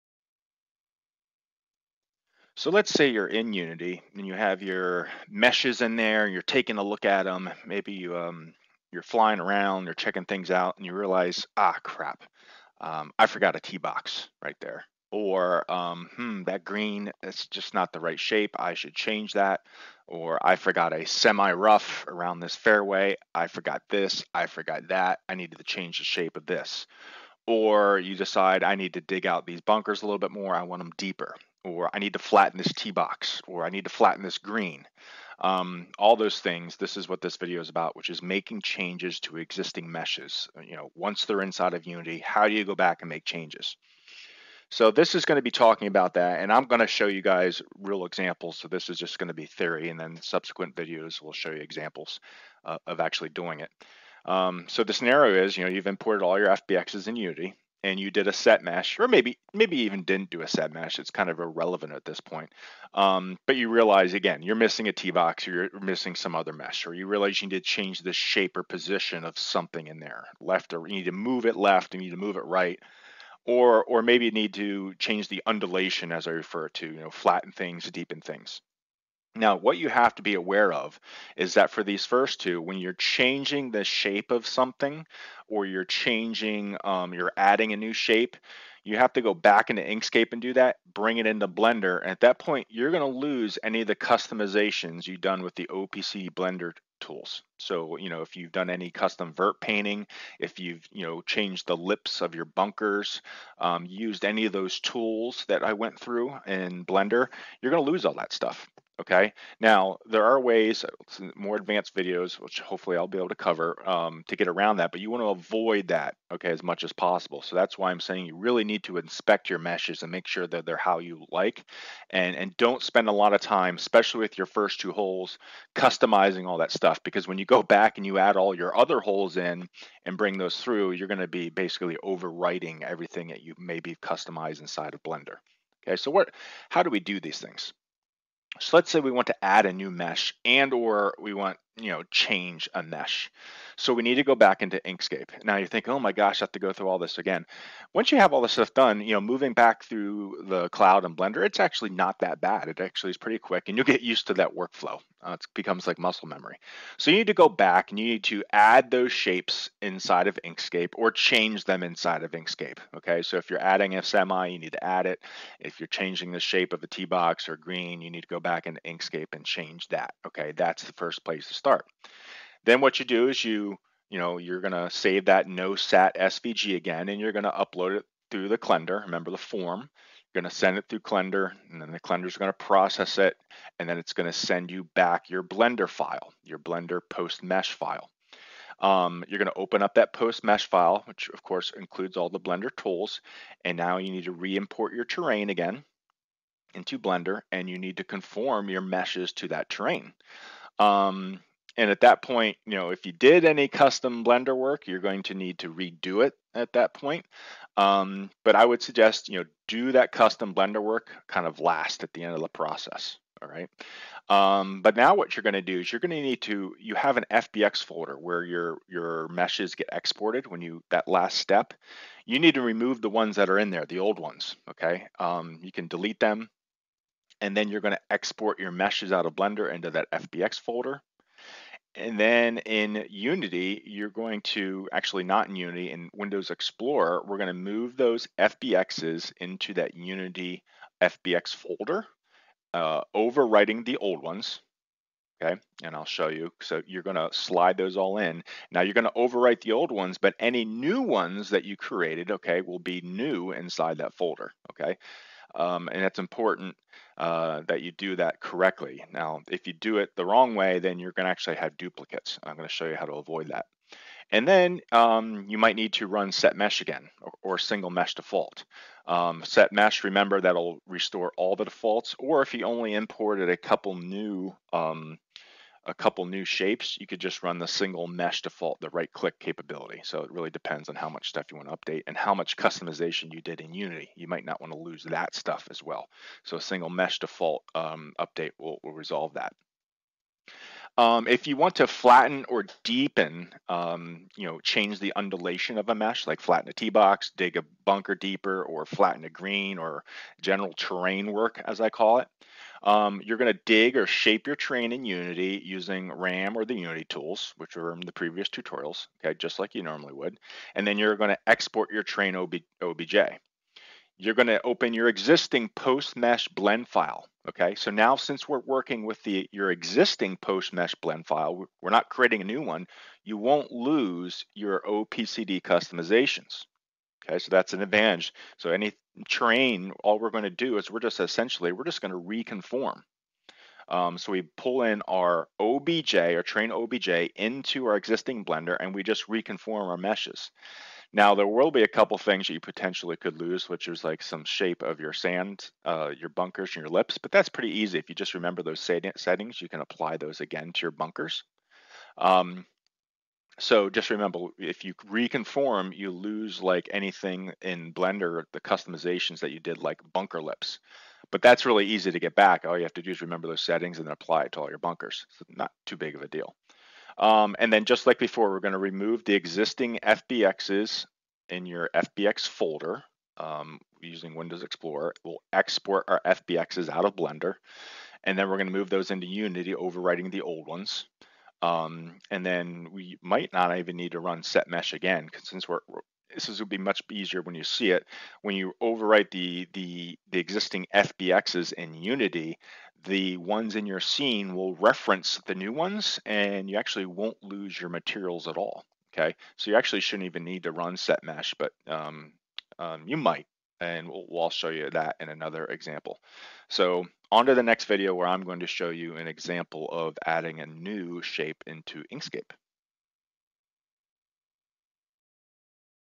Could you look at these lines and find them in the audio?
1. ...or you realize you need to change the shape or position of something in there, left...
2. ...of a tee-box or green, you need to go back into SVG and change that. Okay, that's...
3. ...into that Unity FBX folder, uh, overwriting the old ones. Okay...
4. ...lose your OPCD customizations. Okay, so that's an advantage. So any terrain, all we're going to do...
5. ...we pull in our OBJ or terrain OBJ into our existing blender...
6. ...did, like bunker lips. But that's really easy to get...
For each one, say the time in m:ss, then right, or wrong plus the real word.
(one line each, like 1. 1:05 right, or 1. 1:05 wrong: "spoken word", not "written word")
1. 1:06 right
2. 2:46 wrong: "Inkscape", not "SVG"
3. 3:59 right
4. 5:23 right
5. 5:34 right
6. 5:59 right.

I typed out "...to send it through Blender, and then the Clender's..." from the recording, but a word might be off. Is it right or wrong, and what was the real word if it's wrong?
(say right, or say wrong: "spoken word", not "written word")
wrong: "Clender", not "Blender".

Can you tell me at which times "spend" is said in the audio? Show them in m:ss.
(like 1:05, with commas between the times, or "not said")
2:02.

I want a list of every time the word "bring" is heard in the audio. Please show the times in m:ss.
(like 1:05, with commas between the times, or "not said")
1:30, 2:10.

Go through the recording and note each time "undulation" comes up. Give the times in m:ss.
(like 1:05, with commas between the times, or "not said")
1:15, 4:55.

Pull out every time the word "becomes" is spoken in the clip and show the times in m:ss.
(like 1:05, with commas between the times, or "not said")
2:35.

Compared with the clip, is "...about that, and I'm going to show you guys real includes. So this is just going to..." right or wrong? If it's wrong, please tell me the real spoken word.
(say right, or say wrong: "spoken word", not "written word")
wrong: "examples", not "includes".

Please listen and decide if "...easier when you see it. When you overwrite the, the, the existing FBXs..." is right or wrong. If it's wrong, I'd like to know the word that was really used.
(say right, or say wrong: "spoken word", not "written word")
right.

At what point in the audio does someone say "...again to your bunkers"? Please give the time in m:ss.
5:50.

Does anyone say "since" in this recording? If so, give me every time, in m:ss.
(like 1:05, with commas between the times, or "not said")
5:18, 6:25.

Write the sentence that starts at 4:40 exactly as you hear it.
So it really depends on how much stuff you want to update and how much customization you did in Unity.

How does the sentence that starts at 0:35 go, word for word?
Um, all those things, this is what this video is about, which is making changes to existing meshes.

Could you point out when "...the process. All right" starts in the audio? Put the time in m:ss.
3:32.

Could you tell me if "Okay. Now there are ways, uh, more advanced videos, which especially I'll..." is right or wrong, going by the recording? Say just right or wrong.
wrong.